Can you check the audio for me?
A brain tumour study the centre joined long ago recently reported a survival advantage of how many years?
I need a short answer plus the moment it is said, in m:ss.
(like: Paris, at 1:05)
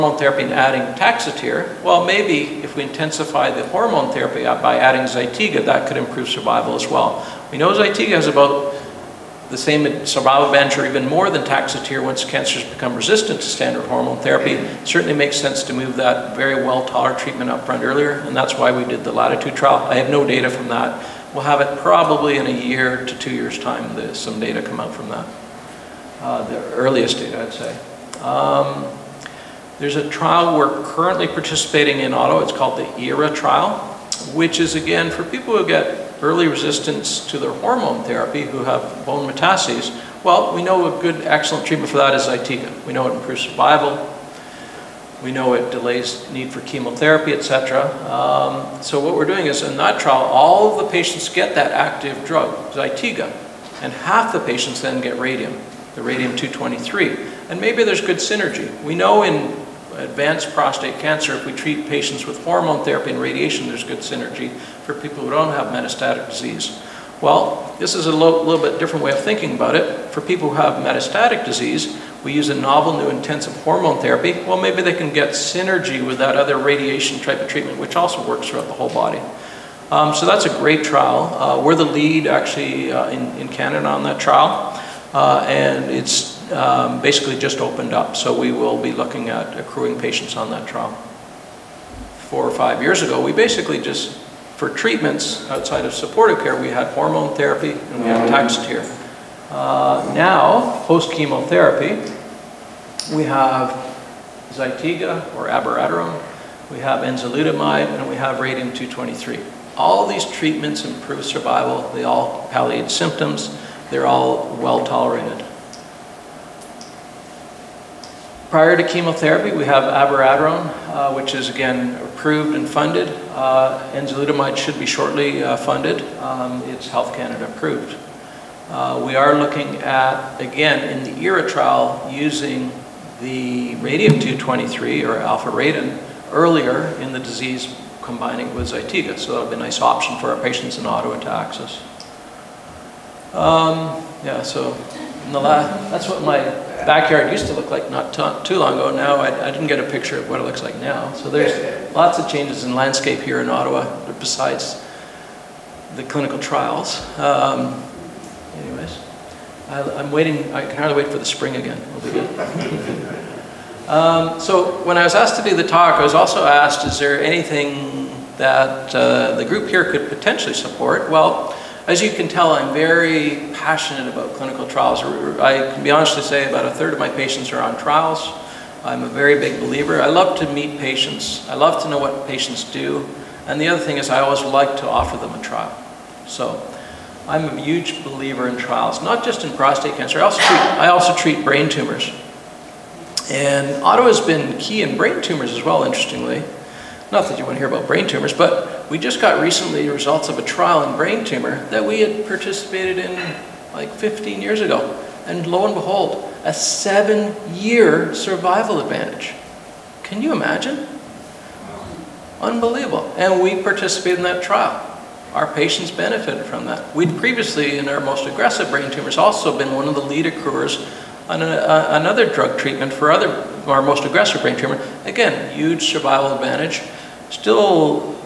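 7 years, at 3:26.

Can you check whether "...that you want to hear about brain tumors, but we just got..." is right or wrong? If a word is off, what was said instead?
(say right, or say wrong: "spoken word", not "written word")
right.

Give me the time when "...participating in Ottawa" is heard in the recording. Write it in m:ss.
0:31.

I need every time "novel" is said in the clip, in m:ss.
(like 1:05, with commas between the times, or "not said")
1:12.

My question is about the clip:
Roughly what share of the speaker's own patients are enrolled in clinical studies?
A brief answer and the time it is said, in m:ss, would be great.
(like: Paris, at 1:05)
About a third, at 2:56.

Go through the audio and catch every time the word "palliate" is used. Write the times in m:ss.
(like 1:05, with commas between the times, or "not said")
1:52.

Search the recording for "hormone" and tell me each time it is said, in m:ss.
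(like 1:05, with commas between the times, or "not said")
0:03, 0:13, 0:37, 1:02, 1:13, 1:36.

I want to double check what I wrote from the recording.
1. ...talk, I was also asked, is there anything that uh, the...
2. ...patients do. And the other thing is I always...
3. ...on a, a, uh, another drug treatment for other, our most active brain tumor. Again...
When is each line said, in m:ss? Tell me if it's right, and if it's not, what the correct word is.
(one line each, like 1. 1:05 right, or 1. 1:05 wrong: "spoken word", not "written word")
1. 2:45 right
2. 3:02 right
3. 3:41 wrong: "aggressive", not "active".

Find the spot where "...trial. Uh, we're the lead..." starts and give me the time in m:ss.
1:20.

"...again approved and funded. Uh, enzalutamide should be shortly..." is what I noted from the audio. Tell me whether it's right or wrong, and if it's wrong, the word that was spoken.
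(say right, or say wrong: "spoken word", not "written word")
right.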